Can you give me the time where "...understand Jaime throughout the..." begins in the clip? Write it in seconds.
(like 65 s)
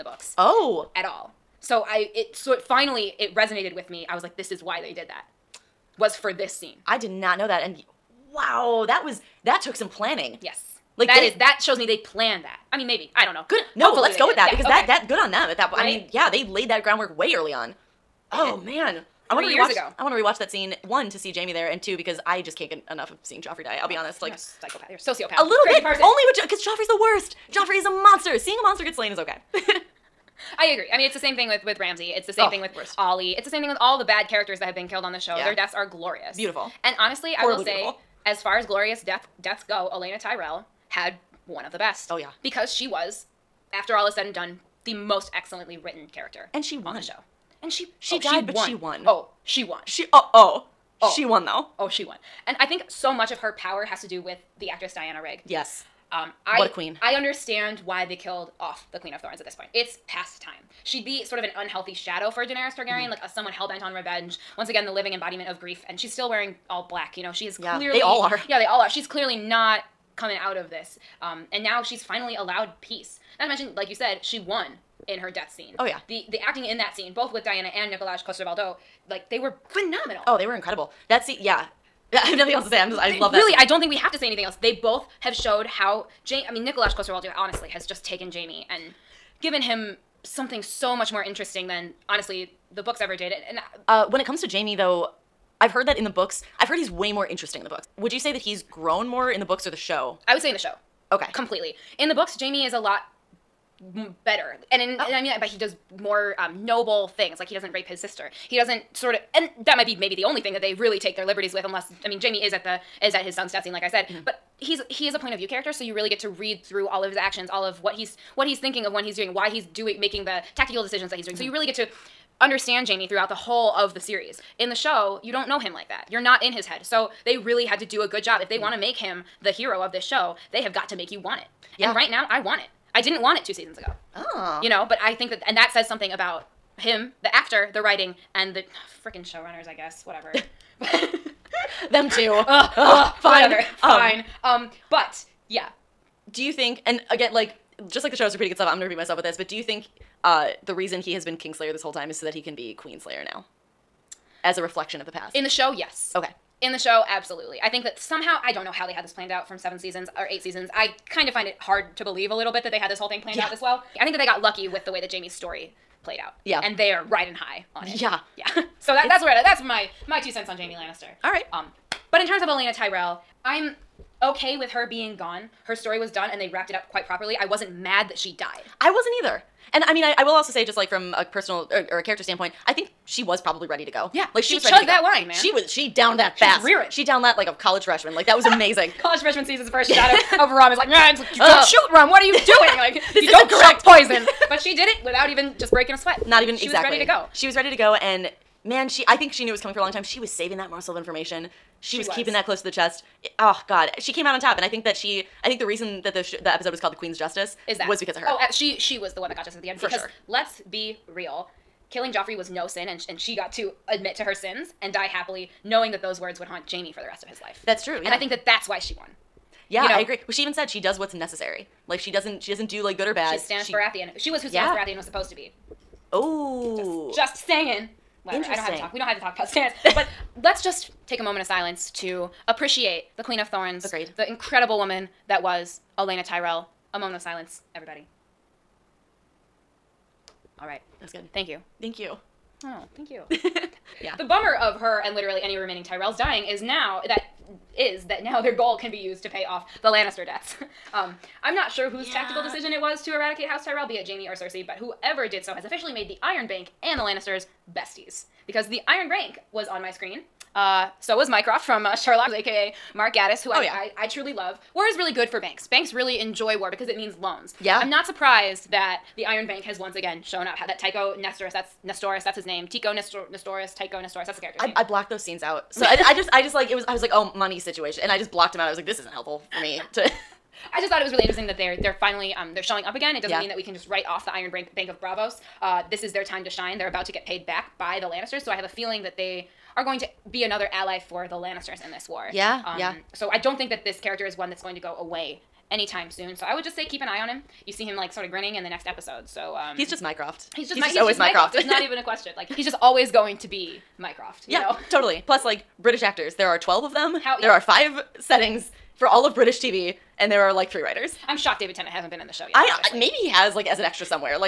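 122 s.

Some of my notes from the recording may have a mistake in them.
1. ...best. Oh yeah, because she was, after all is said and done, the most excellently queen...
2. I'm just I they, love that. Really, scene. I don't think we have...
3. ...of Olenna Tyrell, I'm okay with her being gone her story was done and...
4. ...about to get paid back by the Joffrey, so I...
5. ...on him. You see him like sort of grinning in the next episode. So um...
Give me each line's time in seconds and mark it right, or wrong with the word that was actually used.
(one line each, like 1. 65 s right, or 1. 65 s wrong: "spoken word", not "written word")
1. 41 s wrong: "written", not "queen"
2. 82 s right
3. 172 s right
4. 286 s wrong: "Lannisters", not "Joffrey"
5. 297 s right.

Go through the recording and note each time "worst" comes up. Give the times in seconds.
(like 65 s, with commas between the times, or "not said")
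26 s, 32 s.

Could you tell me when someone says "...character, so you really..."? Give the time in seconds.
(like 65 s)
115 s.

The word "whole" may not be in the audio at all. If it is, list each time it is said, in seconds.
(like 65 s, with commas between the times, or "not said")
123 s, 151 s, 162 s.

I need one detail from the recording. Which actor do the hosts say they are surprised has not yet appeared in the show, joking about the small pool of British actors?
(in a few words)
David Tennant.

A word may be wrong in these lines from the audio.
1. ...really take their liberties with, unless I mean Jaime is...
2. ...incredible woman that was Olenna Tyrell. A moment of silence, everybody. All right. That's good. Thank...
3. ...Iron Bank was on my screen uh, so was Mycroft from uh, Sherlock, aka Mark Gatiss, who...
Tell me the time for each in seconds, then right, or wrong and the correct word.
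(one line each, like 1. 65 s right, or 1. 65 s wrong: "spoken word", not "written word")
1. 110 s right
2. 234 s right
3. 258 s right.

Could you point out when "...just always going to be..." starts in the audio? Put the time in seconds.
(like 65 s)
302 s.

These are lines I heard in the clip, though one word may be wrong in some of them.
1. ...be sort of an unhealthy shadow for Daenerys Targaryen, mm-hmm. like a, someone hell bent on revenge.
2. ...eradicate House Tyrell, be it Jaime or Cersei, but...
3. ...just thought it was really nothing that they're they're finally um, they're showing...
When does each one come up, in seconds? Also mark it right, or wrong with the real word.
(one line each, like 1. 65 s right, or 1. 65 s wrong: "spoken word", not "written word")
1. 61 s right
2. 253 s right
3. 280 s wrong: "interesting", not "nothing".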